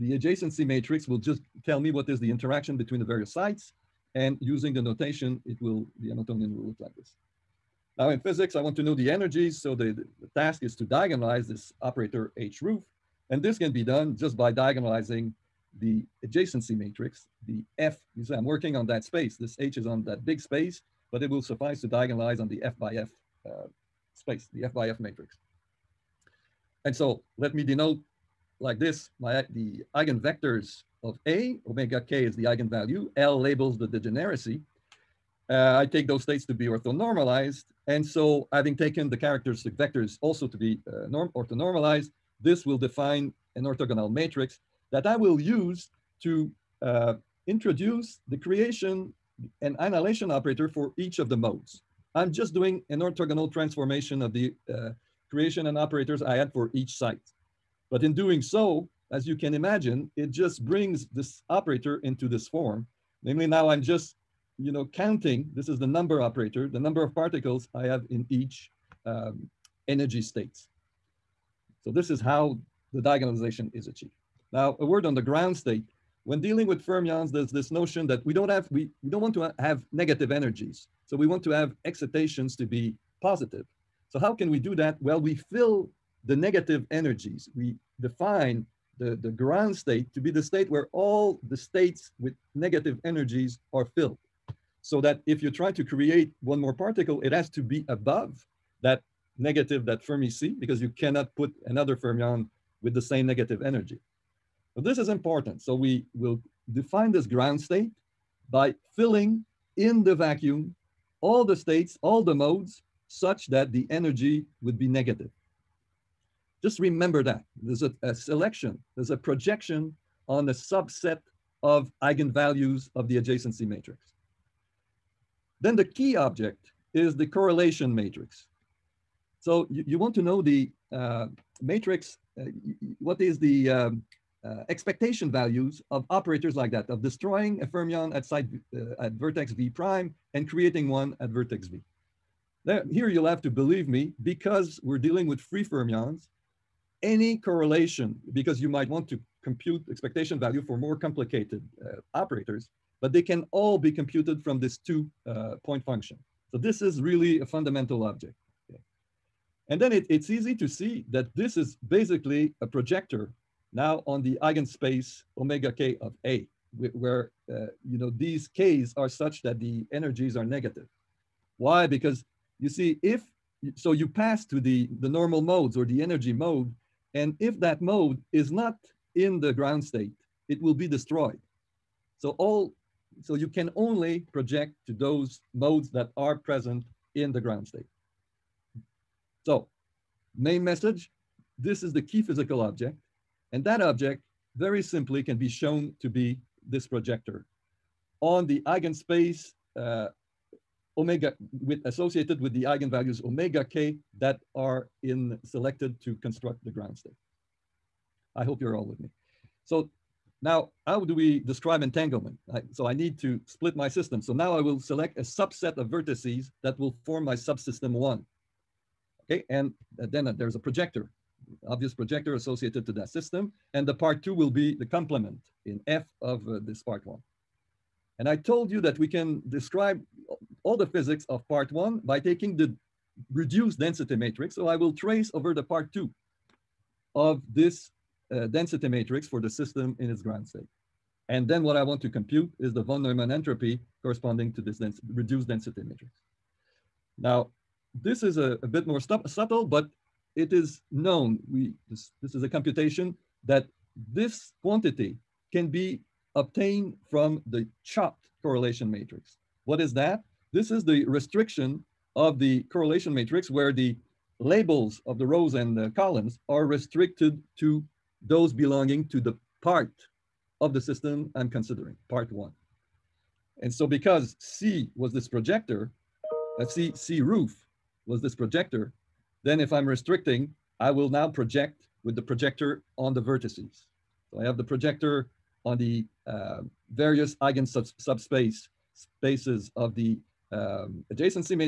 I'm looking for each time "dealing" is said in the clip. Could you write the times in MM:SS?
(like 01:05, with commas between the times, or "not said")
01:16, 02:24.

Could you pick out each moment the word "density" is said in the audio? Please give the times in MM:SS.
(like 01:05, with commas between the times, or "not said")
03:53, 03:58, 04:05.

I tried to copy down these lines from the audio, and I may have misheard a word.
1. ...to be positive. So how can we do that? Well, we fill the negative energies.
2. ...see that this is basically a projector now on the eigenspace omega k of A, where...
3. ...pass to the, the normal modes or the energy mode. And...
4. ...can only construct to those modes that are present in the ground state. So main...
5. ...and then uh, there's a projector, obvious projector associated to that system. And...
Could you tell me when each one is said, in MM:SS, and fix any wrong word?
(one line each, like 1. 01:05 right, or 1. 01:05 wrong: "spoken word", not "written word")
1. 01:22 right
2. 02:40 right
3. 02:54 right
4. 03:03 wrong: "project", not "construct"
5. 03:39 right.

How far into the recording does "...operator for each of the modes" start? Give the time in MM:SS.
00:50.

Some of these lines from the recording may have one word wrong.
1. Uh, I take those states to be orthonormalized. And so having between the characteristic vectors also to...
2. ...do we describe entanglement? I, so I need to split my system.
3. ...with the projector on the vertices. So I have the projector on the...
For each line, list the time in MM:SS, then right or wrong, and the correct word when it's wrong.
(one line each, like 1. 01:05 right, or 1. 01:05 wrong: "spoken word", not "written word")
1. 00:35 wrong: "taken", not "between"
2. 03:31 right
3. 04:42 right.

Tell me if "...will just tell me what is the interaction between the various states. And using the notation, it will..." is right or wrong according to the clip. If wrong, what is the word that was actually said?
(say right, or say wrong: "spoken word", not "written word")
wrong: "sites", not "states".